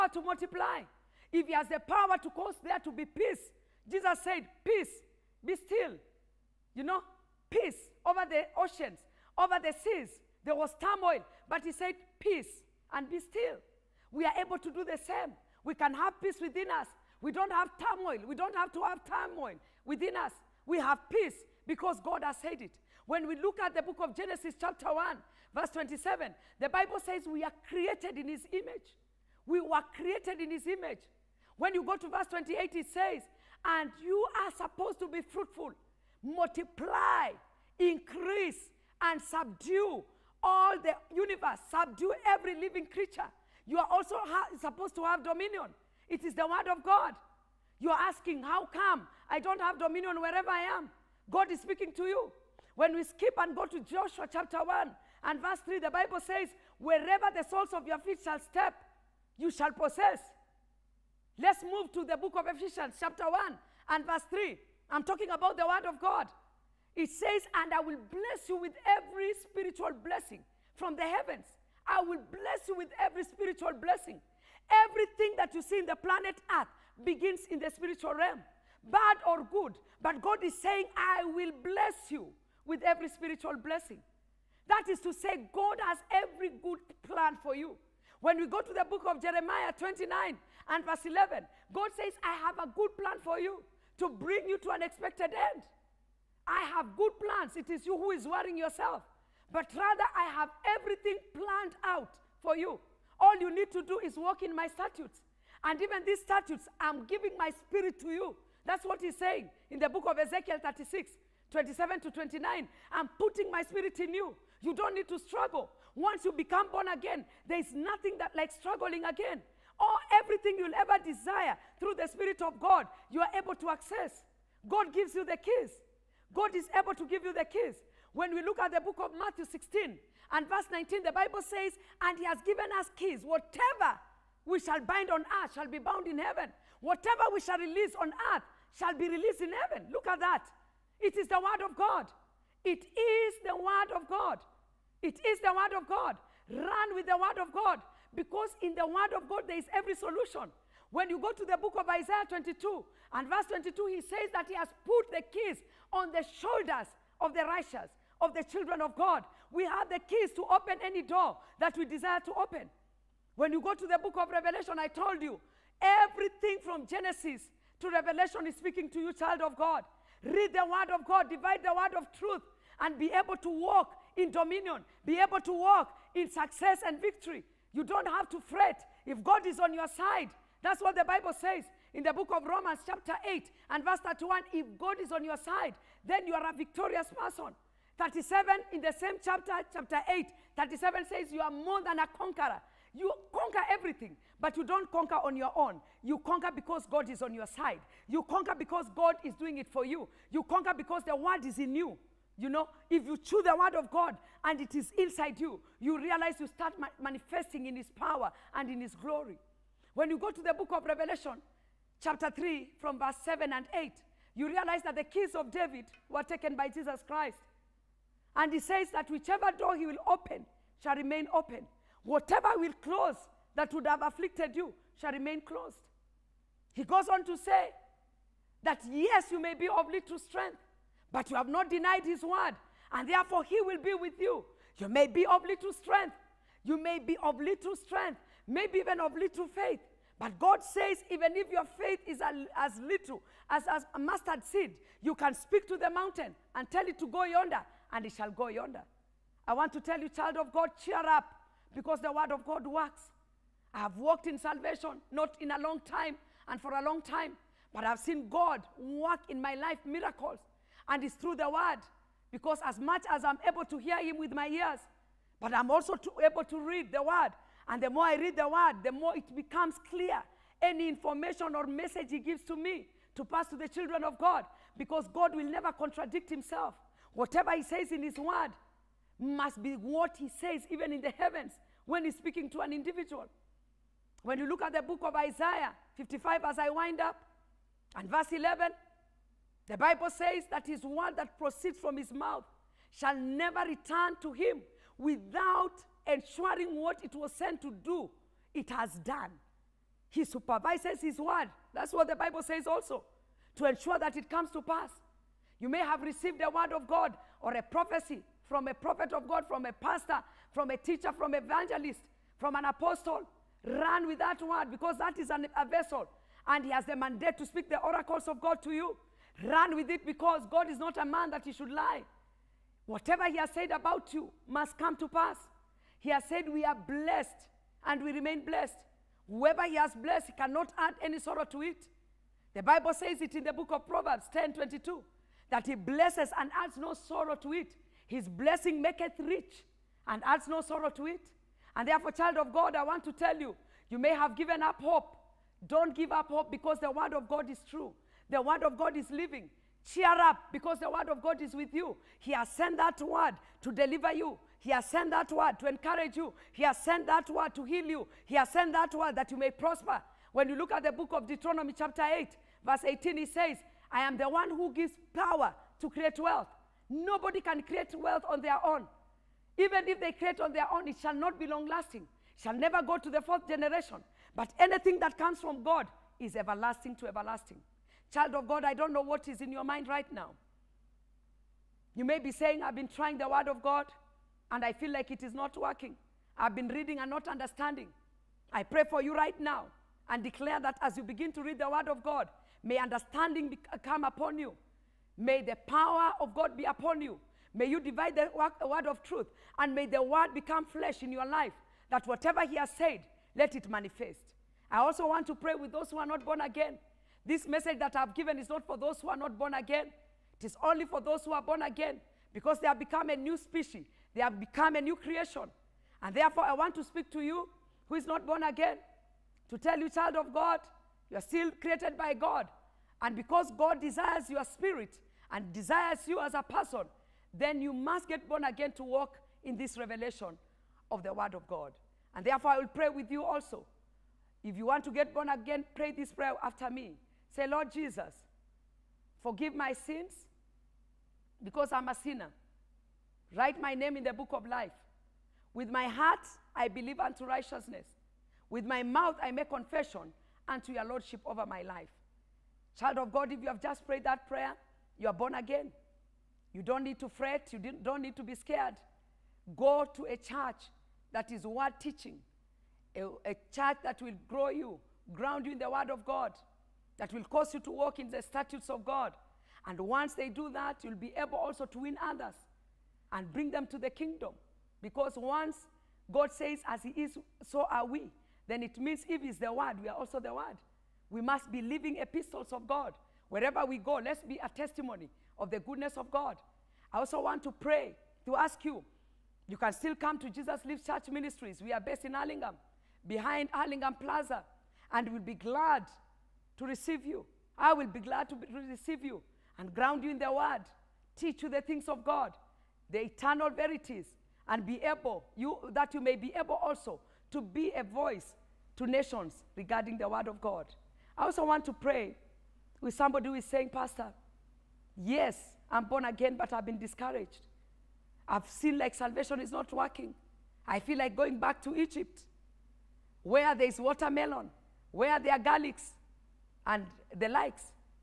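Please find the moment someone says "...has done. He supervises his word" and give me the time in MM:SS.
04:58.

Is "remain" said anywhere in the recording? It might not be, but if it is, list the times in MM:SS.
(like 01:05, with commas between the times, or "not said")
03:40, 03:45, 05:28.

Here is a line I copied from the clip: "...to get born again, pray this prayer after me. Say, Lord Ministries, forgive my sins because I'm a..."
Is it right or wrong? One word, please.
wrong.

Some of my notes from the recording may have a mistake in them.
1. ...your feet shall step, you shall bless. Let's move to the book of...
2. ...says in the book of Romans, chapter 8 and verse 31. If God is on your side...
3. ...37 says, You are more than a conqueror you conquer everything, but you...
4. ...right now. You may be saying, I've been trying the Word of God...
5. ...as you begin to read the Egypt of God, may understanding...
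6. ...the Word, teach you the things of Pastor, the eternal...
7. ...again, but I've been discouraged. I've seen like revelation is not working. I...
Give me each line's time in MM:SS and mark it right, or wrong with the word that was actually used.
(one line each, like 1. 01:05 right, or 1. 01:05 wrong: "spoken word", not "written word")
1. 00:57 wrong: "possess", not "bless"
2. 03:01 right
3. 03:10 right
4. 06:19 right
5. 06:30 wrong: "Word", not "Egypt"
6. 08:20 wrong: "God", not "Pastor"
7. 08:36 wrong: "salvation", not "revelation".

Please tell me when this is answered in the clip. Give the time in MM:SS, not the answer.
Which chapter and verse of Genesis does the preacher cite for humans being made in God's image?
00:24.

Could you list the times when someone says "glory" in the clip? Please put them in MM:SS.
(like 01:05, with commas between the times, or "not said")
03:28.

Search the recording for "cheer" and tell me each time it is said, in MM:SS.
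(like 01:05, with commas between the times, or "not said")
04:10, 05:49.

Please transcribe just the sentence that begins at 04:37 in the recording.
Whatever He says in His word, must be what he says, even in the heavens, when he's speaking to an individual.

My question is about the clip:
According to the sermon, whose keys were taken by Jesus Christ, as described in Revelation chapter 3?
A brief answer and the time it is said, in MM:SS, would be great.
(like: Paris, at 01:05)
David, at 03:34.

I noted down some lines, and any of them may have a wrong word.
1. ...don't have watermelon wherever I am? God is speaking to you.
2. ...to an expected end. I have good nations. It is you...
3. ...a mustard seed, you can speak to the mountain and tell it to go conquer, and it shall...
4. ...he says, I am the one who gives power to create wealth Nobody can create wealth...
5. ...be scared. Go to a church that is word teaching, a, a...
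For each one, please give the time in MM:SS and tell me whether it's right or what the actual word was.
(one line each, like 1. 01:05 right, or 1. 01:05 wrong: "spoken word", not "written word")
1. 00:49 wrong: "dominion", not "watermelon"
2. 01:34 wrong: "plans", not "nations"
3. 04:03 wrong: "yonder", not "conquer"
4. 06:03 right
5. 07:38 right.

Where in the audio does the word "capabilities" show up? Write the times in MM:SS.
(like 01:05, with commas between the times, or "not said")
not said.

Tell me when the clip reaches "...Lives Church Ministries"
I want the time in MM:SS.
08:10.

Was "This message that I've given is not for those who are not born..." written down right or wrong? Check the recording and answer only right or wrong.
right.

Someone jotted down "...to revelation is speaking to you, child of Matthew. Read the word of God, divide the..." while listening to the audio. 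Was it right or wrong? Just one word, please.
wrong.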